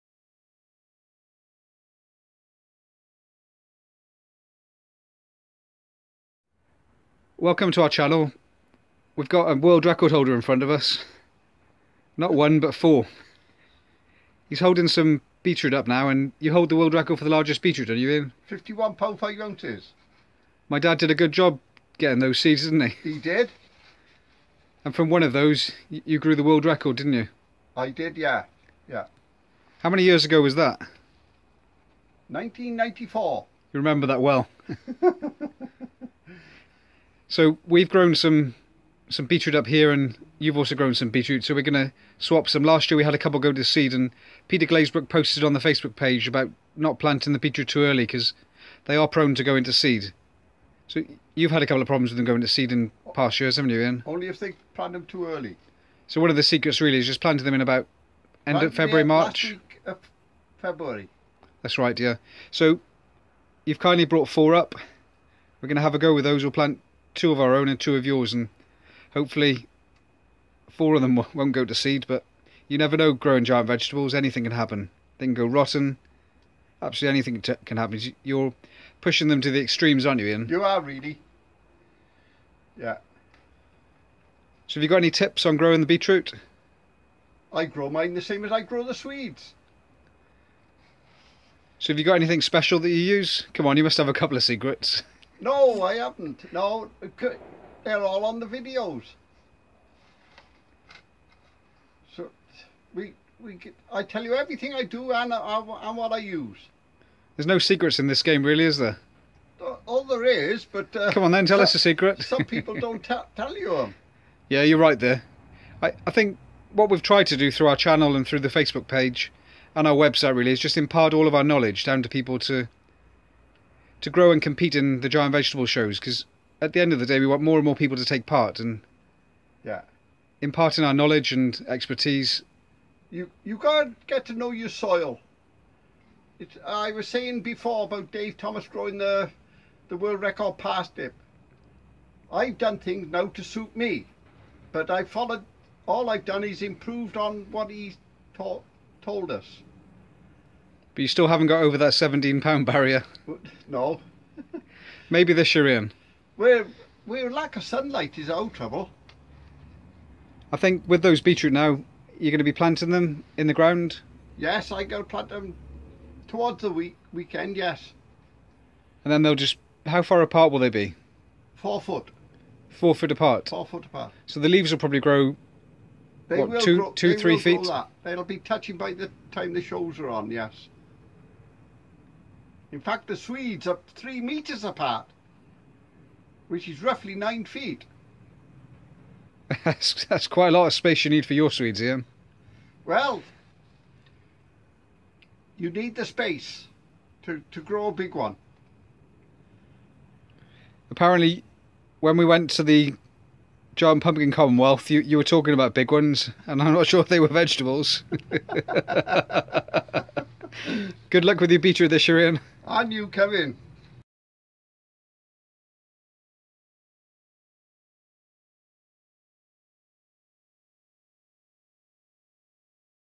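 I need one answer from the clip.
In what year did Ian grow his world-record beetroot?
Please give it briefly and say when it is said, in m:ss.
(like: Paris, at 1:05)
1994, at 0:32.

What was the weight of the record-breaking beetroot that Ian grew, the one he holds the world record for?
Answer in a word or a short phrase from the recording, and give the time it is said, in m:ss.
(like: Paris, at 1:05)
51 pound 5 ounces, at 0:18.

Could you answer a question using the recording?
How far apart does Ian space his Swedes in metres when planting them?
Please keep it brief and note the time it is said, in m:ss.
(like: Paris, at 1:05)
3 metres, at 3:03.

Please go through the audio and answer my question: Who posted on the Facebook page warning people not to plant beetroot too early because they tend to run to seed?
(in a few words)
Peter Glazebrook.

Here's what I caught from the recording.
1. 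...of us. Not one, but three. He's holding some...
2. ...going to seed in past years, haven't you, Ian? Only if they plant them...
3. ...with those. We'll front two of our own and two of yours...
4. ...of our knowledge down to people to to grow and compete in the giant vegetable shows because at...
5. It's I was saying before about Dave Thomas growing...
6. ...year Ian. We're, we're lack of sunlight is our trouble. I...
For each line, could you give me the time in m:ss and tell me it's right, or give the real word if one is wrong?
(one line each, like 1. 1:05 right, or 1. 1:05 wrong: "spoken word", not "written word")
1. 0:10 wrong: "four", not "three"
2. 0:52 right
3. 1:06 wrong: "plant", not "front"
4. 2:01 right
5. 2:16 right
6. 2:35 right.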